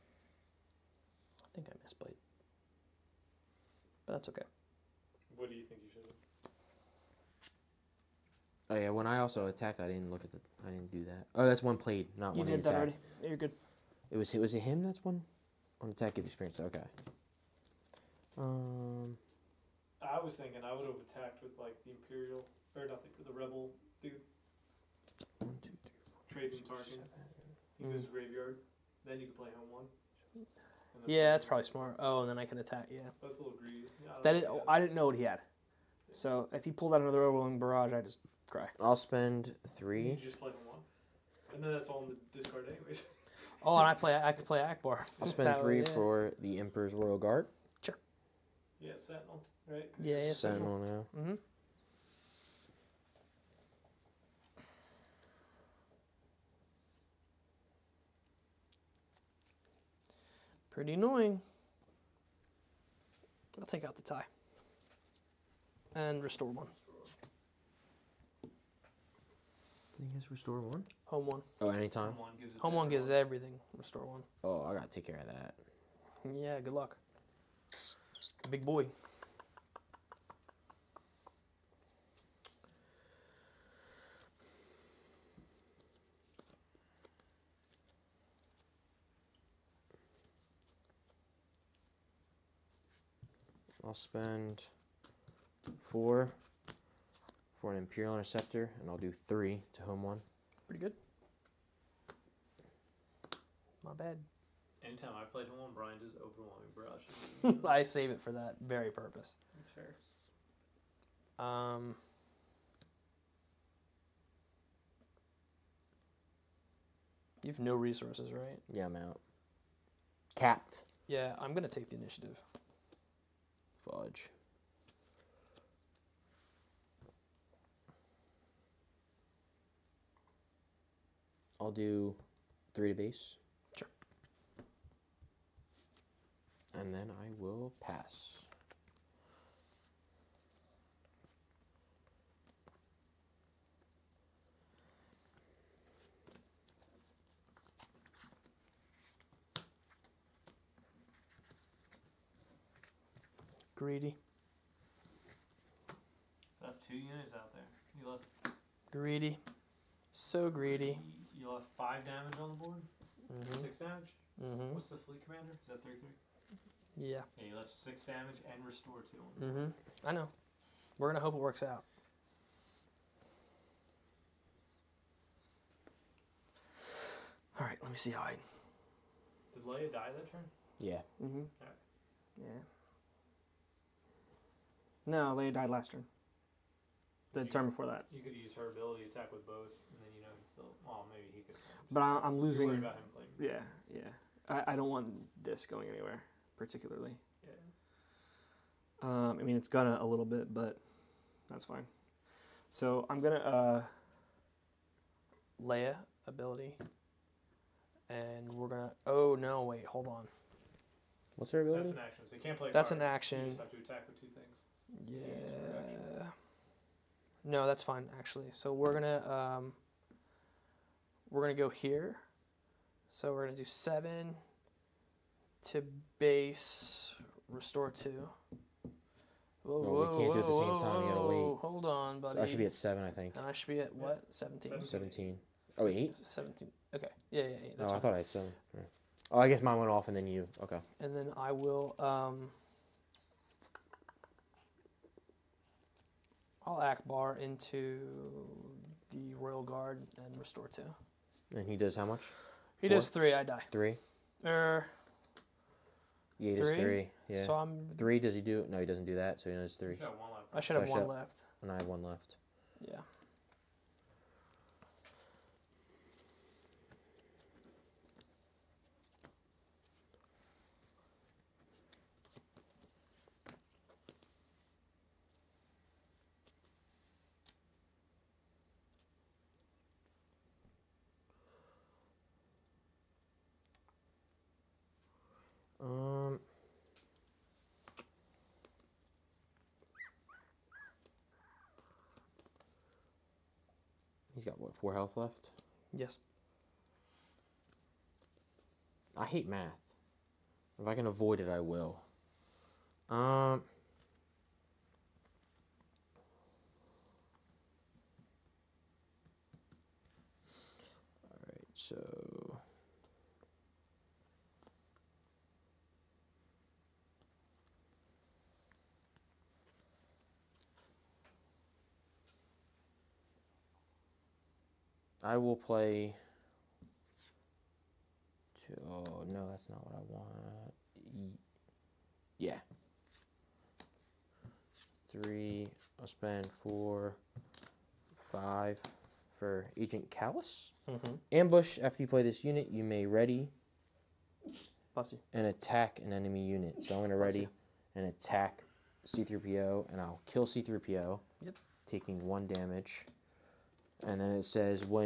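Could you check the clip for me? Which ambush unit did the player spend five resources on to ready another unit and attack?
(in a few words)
Agent Kallus.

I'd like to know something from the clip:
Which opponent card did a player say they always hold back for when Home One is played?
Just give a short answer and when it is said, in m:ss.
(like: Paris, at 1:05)
Overwhelming Barrage, at 1:46.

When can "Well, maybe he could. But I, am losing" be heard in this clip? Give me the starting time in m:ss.
3:10.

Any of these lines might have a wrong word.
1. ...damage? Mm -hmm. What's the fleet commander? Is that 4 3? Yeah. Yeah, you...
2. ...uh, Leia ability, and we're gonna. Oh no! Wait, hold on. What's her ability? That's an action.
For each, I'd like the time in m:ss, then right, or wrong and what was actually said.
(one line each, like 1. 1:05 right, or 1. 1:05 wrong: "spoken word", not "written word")
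1. 2:43 wrong: "3", not "4"
2. 3:23 right.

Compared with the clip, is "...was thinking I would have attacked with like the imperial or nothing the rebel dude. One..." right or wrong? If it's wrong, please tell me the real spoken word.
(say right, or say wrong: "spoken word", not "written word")
right.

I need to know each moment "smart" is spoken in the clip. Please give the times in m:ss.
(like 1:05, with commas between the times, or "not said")
0:31.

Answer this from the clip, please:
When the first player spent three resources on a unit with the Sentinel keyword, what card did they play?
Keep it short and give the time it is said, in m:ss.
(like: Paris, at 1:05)
Emperor's Royal Guard, at 0:46.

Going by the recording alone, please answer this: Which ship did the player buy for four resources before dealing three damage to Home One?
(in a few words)
Imperial Interceptor.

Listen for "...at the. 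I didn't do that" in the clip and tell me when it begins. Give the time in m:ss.
0:10.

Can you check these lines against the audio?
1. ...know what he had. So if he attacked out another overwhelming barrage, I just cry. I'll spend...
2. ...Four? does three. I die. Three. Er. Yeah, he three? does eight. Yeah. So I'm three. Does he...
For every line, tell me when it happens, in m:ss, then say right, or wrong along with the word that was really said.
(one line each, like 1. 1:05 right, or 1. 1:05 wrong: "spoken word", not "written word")
1. 0:34 wrong: "pulled", not "attacked"
2. 4:12 wrong: "three", not "eight".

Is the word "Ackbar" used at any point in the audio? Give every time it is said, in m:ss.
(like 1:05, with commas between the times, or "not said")
0:44, 4:06.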